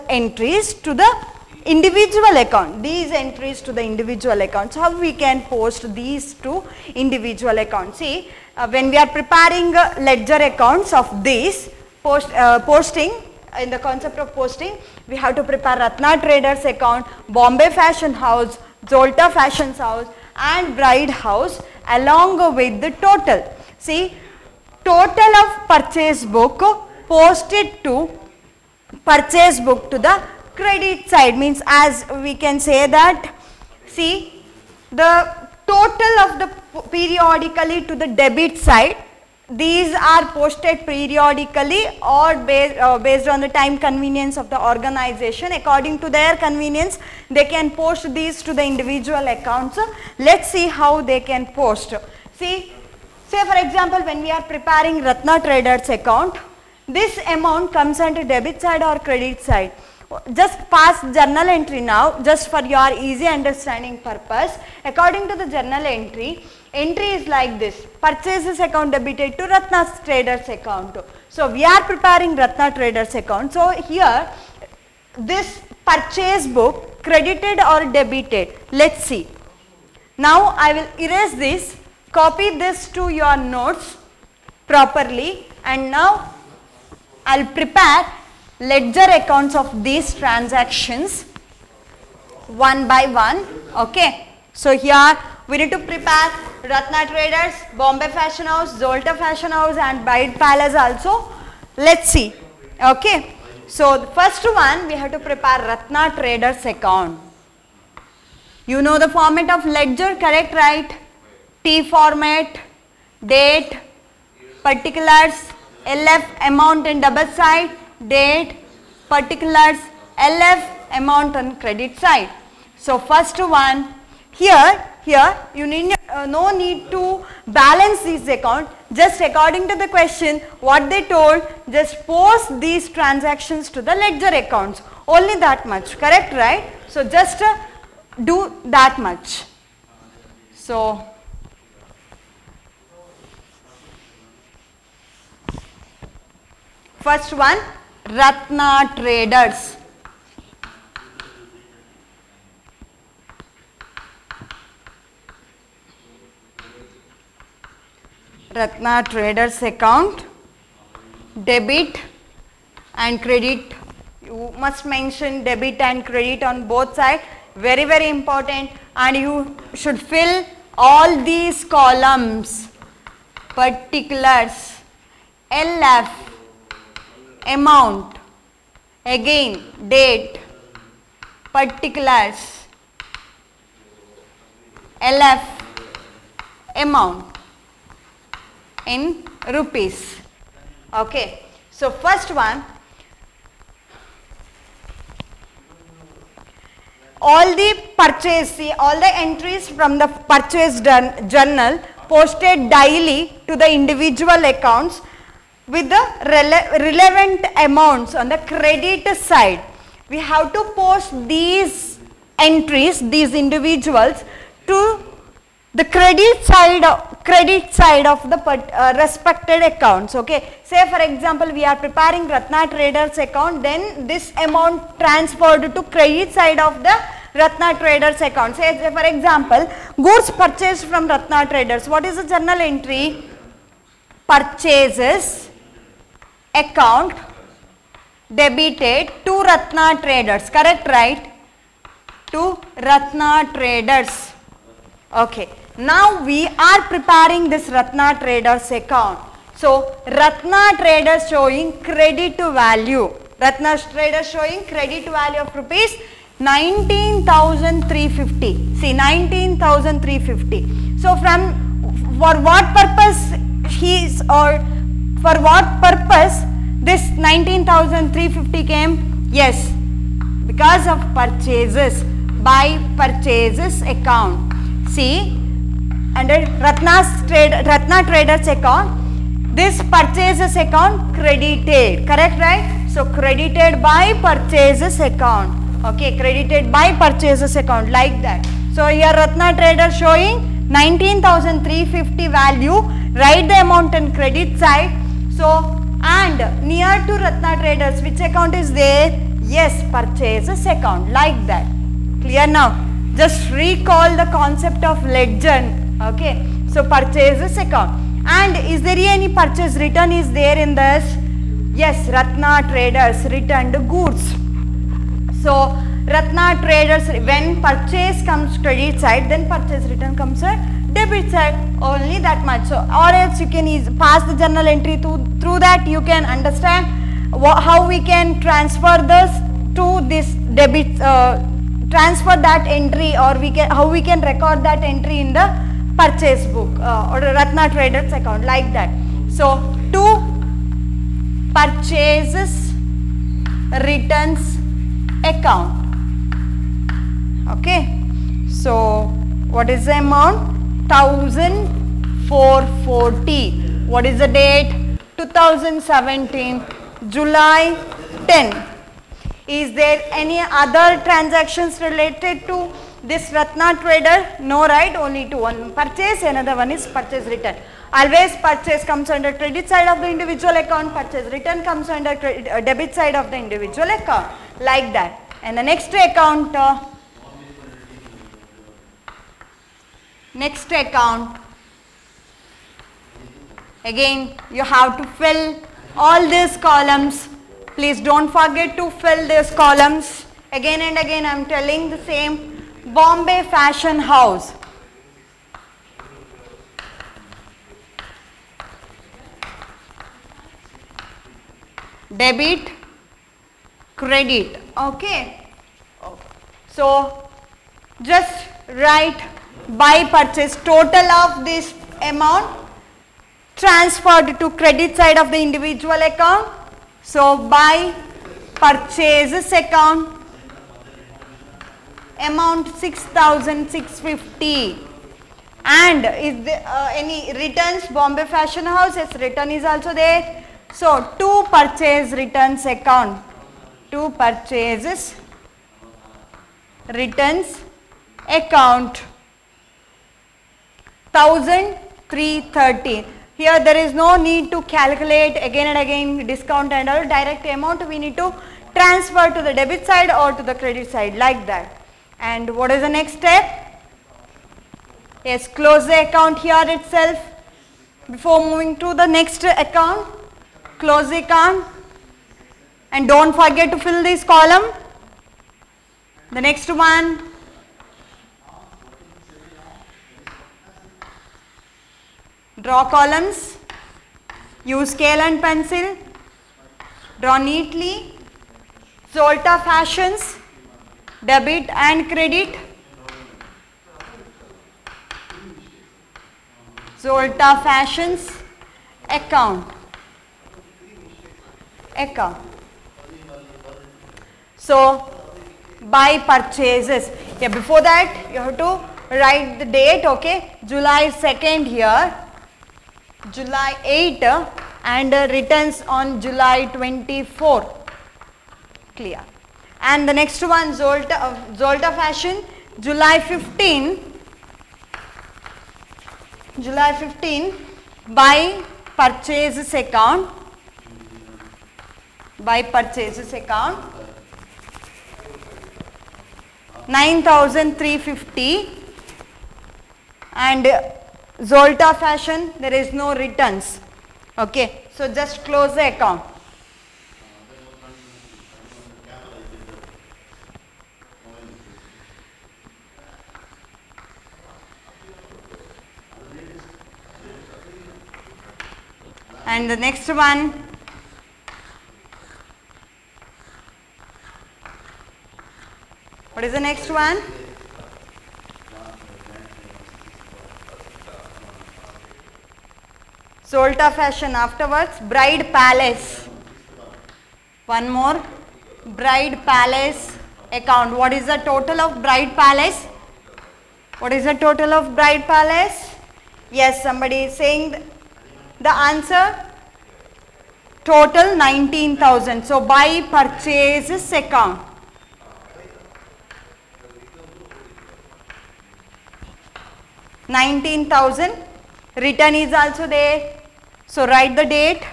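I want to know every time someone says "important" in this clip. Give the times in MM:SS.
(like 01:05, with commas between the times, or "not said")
02:48.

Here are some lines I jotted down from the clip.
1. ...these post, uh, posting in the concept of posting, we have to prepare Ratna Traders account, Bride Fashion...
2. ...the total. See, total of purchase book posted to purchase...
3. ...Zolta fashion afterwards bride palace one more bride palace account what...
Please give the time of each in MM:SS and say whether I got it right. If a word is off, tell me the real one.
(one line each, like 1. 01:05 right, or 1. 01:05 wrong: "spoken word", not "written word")
1. 00:11 wrong: "Bombay", not "Bride"
2. 00:22 right
3. 09:23 right.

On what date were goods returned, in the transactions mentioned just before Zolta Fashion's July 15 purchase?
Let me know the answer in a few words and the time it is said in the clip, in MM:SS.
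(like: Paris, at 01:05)
July 24, at 08:26.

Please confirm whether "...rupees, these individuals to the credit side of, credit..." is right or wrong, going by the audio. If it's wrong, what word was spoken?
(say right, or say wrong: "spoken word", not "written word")
wrong: "entries", not "rupees".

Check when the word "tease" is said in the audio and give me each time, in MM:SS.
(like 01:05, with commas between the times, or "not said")
not said.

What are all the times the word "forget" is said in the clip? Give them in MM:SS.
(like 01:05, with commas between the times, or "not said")
06:28, 07:43.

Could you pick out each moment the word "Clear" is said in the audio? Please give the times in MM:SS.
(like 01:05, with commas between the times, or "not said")
05:02, 08:28.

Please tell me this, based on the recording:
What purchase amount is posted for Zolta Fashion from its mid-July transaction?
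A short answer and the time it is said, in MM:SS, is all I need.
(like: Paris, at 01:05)
9350, at 08:46.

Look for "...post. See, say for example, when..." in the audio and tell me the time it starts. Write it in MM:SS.
00:51.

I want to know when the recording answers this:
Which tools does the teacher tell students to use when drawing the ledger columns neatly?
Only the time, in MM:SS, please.
07:54.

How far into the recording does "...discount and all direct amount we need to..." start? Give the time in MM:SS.
07:26.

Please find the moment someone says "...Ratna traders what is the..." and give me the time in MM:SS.
03:51.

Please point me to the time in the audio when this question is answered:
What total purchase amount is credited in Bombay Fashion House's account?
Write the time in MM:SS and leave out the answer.
07:02.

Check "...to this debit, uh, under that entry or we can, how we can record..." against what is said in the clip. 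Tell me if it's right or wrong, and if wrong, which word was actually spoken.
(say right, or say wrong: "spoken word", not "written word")
wrong: "transfer", not "under".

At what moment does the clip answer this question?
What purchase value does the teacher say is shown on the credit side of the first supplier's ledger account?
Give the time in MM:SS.
04:15.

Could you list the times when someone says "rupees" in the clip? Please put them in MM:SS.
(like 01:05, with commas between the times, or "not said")
03:09, 04:15.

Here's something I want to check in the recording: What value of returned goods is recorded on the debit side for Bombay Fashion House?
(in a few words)
1330.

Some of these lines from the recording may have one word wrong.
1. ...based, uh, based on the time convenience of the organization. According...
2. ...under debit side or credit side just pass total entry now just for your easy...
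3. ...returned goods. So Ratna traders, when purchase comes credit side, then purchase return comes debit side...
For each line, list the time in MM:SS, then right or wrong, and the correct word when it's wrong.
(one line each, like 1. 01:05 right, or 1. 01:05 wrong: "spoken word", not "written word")
1. 00:42 right
2. 00:57 wrong: "journal", not "total"
3. 05:13 right.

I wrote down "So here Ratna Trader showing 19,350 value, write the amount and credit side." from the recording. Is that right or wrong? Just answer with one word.
right.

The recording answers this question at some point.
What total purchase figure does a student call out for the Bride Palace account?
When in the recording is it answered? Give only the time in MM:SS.
09:40.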